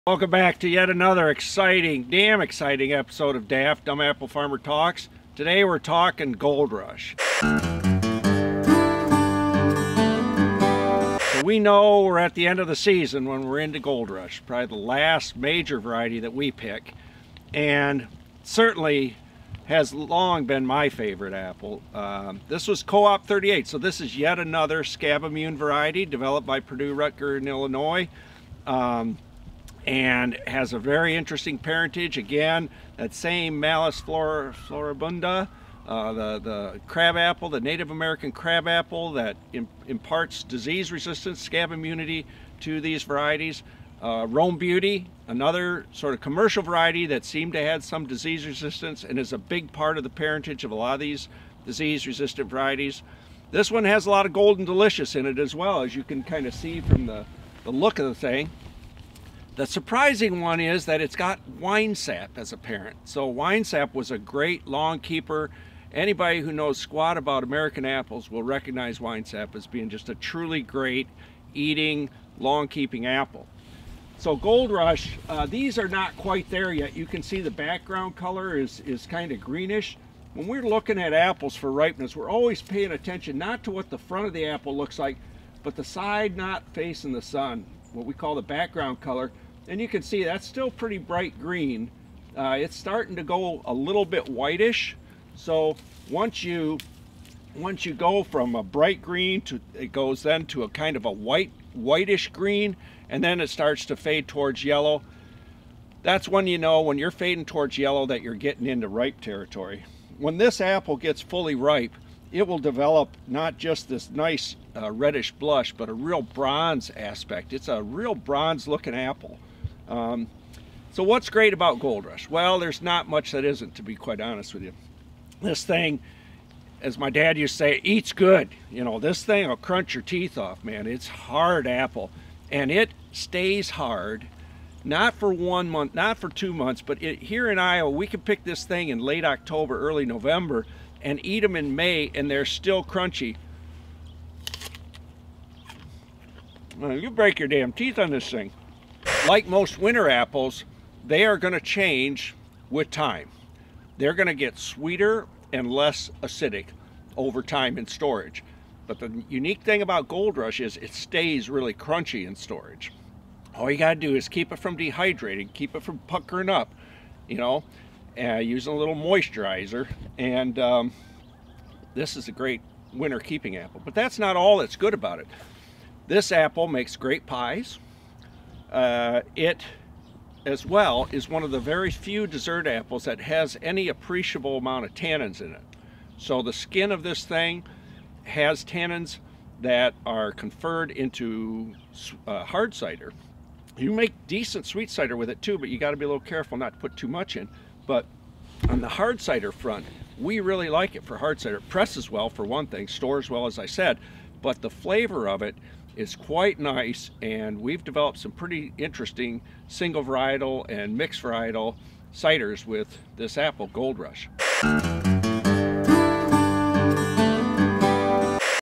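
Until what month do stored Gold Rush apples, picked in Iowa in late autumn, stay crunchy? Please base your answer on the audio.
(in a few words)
May.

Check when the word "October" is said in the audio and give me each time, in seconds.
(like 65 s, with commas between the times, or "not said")
139 s.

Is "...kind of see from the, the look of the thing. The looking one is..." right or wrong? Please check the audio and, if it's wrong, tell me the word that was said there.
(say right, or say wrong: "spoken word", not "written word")
wrong: "surprising", not "looking".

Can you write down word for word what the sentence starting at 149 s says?
Like most winter apples, they are going to change with time.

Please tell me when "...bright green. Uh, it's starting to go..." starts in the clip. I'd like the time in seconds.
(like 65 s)
90 s.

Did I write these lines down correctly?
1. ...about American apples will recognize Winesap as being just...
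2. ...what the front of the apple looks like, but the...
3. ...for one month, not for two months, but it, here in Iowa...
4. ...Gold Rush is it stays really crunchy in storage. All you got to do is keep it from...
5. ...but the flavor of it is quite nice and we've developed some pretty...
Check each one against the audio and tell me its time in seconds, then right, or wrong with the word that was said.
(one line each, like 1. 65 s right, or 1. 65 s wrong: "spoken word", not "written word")
1. 67 s right
2. 83 s right
3. 135 s right
4. 160 s right
5. 204 s right.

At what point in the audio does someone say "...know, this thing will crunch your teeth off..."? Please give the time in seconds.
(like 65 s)
128 s.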